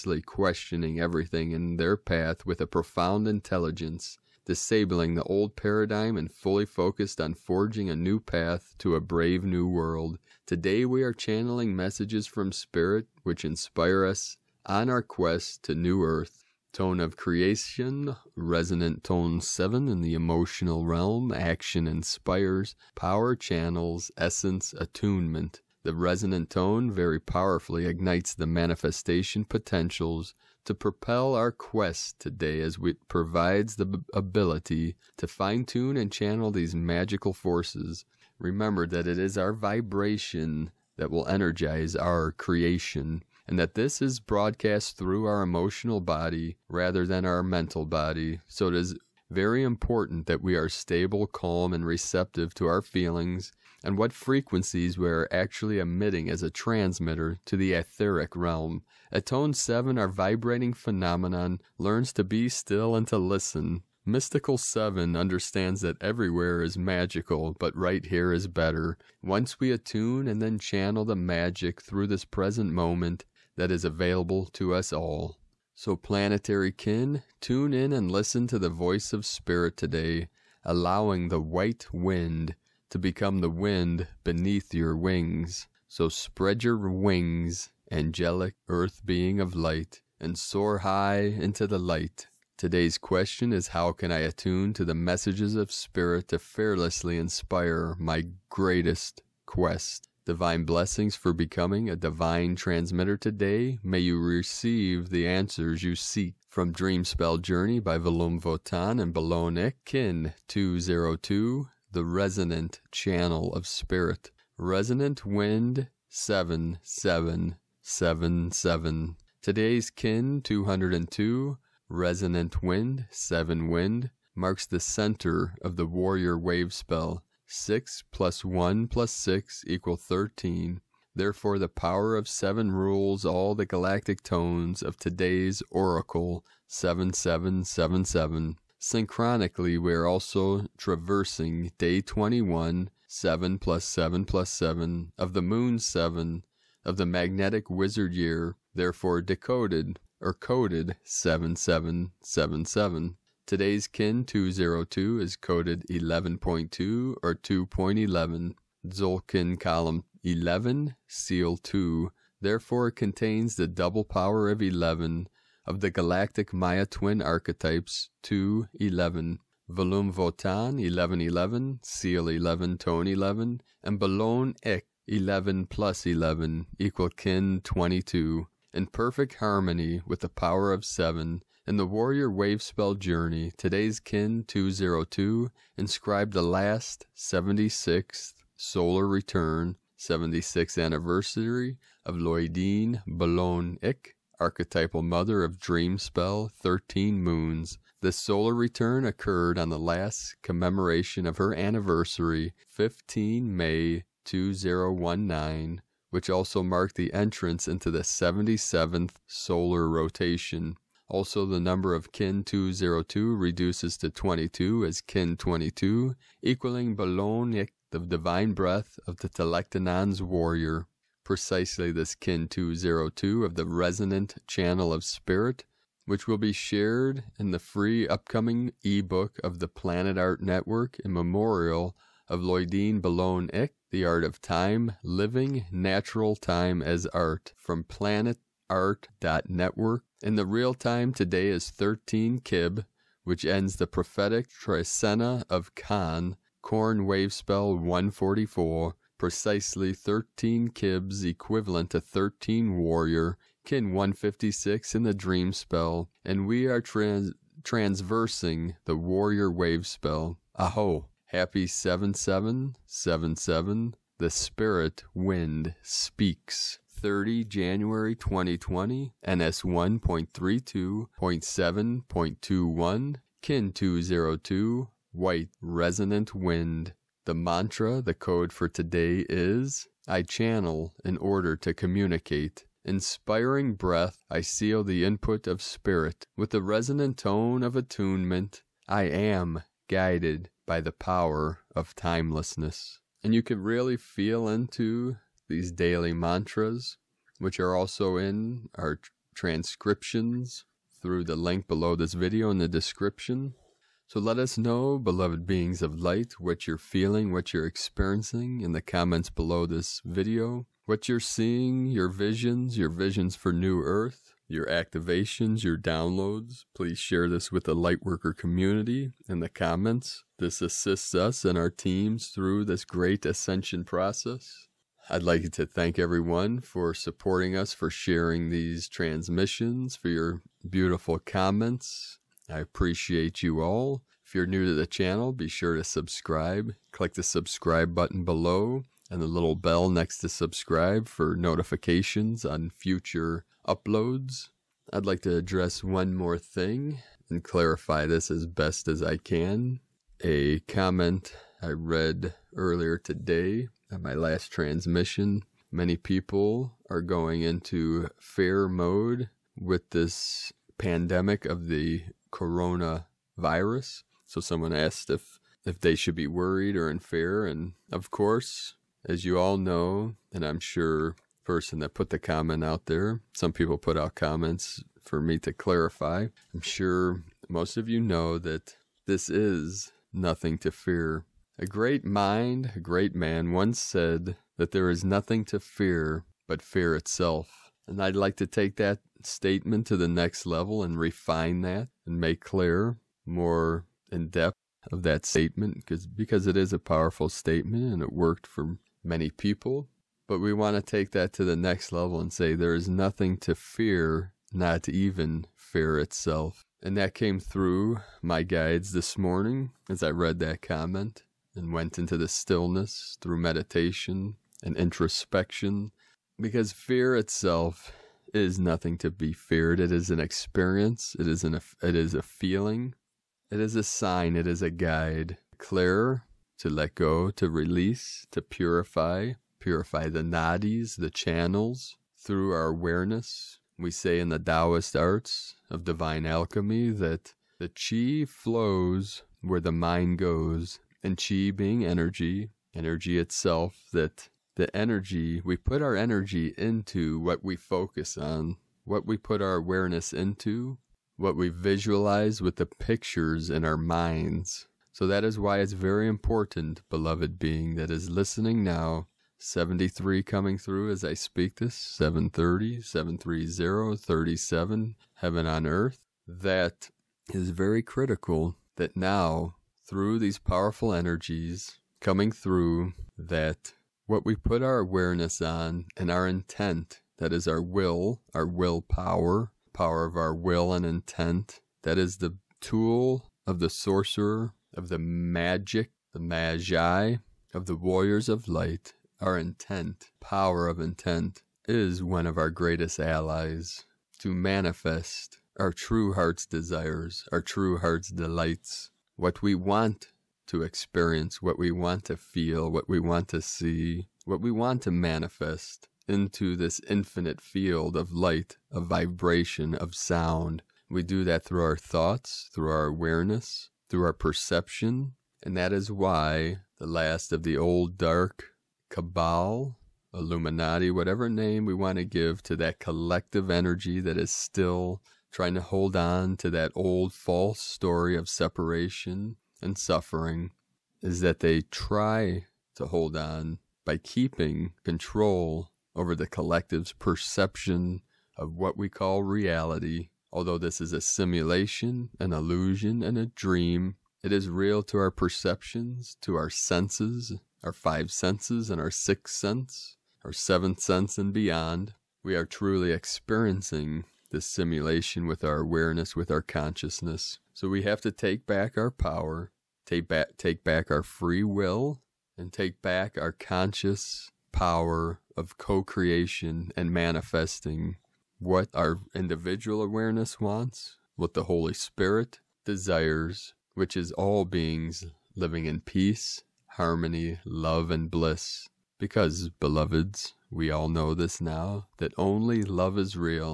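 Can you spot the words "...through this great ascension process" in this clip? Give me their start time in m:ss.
5:22.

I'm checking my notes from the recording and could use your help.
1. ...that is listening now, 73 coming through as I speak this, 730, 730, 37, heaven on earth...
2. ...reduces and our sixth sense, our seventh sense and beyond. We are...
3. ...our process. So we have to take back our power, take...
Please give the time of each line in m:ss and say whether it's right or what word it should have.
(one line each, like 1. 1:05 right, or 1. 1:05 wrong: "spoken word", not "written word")
1. 7:37 right
2. 9:08 wrong: "senses", not "reduces"
3. 9:16 wrong: "consciousness", not "process".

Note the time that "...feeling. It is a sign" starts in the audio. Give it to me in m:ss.
7:02.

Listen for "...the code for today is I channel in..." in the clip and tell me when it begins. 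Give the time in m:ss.
4:37.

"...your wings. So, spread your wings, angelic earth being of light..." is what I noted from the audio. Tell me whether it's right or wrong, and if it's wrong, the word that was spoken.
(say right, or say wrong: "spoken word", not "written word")
right.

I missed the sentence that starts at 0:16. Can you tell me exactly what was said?
Tone of Creation, Resonant Tone 7 in the emotional realm, Action Inspires, Power Channels, Essence Attunement.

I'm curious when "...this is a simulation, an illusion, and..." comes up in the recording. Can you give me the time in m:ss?
9:00.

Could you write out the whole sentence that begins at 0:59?
At tone 7, our vibrating phenomenon learns to be still and to listen.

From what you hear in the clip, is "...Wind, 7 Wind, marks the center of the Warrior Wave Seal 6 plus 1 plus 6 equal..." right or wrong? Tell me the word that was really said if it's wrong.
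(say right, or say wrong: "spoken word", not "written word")
wrong: "Spell", not "Seal".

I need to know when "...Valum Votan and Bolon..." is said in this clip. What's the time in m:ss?
1:47.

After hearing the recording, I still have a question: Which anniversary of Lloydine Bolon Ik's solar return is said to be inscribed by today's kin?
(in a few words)
76th.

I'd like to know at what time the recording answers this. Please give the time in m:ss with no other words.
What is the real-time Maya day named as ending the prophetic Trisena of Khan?
4:01.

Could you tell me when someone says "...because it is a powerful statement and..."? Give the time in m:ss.
6:36.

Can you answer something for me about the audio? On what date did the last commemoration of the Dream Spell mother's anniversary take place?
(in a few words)
15 May 2019.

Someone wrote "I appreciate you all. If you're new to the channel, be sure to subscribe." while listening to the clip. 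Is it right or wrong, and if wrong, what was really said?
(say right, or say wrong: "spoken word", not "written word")
right.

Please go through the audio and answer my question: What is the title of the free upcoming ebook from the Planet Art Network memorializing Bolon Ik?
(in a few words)
The Art of Time.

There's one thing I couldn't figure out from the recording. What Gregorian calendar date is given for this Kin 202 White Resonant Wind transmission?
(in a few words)
30 January 2020.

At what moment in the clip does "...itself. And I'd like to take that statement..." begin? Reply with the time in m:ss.
6:26.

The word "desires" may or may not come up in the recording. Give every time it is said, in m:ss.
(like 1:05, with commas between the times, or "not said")
8:16, 9:32.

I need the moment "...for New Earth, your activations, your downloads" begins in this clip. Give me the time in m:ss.
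5:13.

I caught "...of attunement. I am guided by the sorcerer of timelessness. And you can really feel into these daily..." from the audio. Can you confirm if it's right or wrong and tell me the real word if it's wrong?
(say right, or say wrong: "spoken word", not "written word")
wrong: "power", not "sorcerer".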